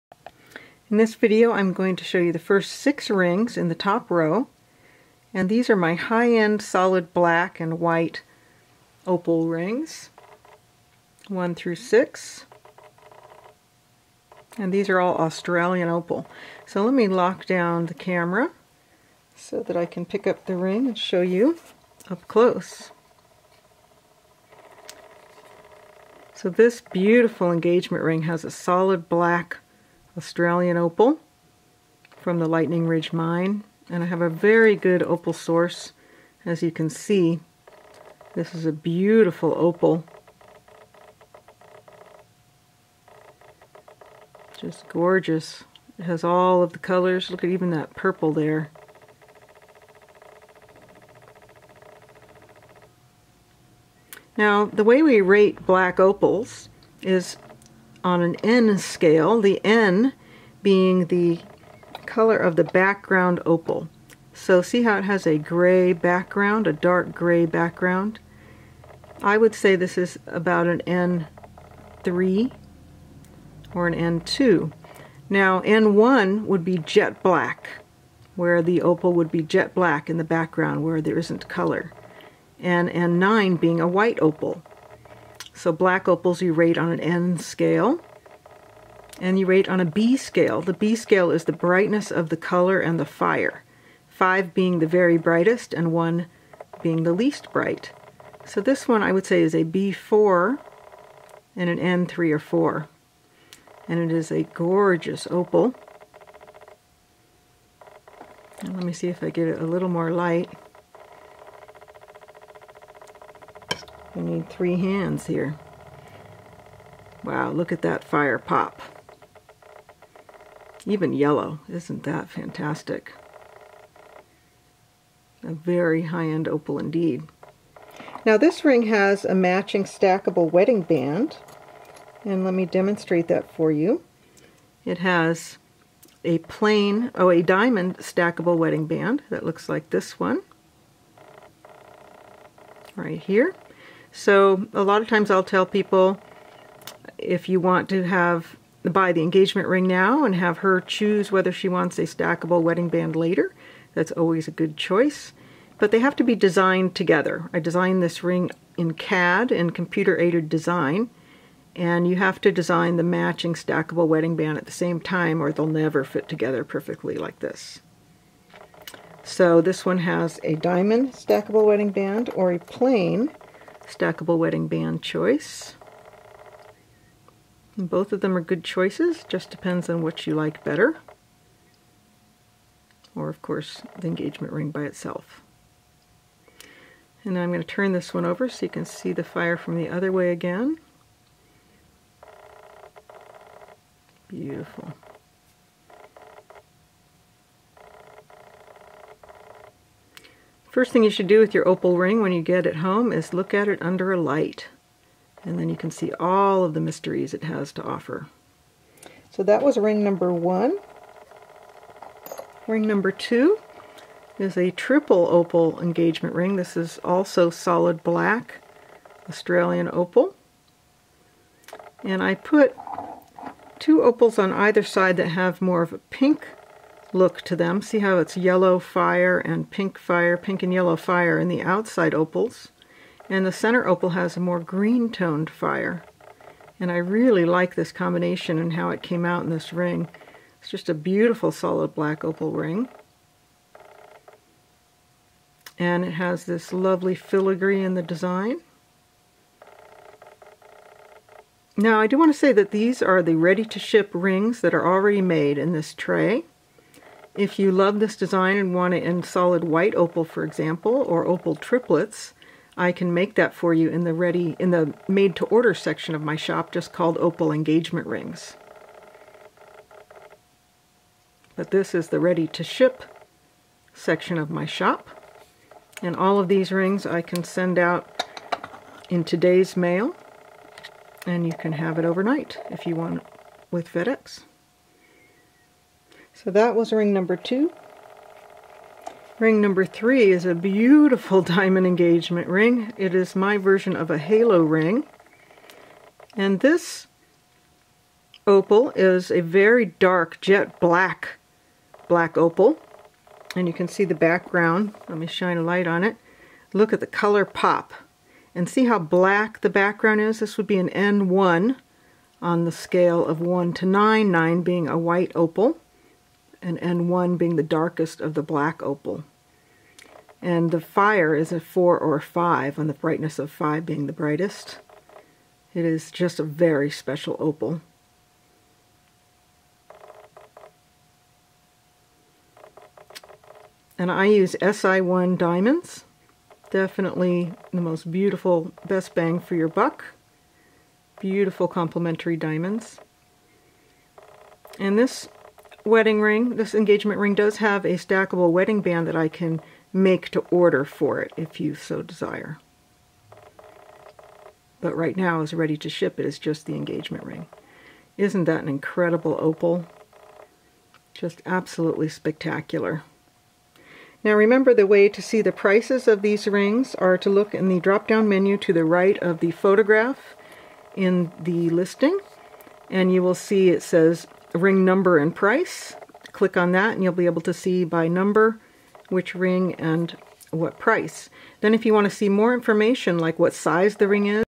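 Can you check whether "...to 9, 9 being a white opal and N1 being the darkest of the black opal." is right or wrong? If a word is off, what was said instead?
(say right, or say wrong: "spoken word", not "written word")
right.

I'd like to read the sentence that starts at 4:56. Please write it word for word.
And this opal is a very dark jet black, black opal.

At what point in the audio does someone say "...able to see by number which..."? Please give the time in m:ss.
6:17.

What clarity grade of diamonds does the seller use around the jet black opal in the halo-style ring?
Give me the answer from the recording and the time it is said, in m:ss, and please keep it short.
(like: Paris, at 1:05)
SI1, at 5:34.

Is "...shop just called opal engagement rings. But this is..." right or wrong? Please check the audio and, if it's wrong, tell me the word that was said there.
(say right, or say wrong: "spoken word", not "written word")
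right.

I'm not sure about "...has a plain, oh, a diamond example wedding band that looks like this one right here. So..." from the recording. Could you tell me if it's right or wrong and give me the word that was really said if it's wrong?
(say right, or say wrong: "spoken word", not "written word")
wrong: "stackable", not "example".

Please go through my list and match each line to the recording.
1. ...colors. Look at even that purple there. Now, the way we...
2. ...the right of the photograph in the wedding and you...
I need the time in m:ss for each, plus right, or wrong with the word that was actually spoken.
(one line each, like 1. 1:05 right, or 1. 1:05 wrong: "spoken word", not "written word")
1. 0:46 right
2. 6:08 wrong: "listing", not "wedding".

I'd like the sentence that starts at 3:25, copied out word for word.
And then you can see all of the mysteries it has to offer.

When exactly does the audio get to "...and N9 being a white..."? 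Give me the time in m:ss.
1:22.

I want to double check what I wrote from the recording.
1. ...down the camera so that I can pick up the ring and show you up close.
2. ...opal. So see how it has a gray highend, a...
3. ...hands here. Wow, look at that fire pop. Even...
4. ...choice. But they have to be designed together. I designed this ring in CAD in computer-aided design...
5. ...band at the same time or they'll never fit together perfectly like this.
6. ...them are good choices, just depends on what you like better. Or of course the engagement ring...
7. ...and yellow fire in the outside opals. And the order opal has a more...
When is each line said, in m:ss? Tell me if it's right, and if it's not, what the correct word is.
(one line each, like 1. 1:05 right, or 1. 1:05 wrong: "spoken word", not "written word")
1. 0:17 right
2. 1:03 wrong: "background", not "highend"
3. 1:54 right
4. 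2:34 right
5. 2:44 right
6. 2:58 right
7. 3:50 wrong: "center", not "order".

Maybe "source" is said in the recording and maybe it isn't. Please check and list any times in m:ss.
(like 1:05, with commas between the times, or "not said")
0:35.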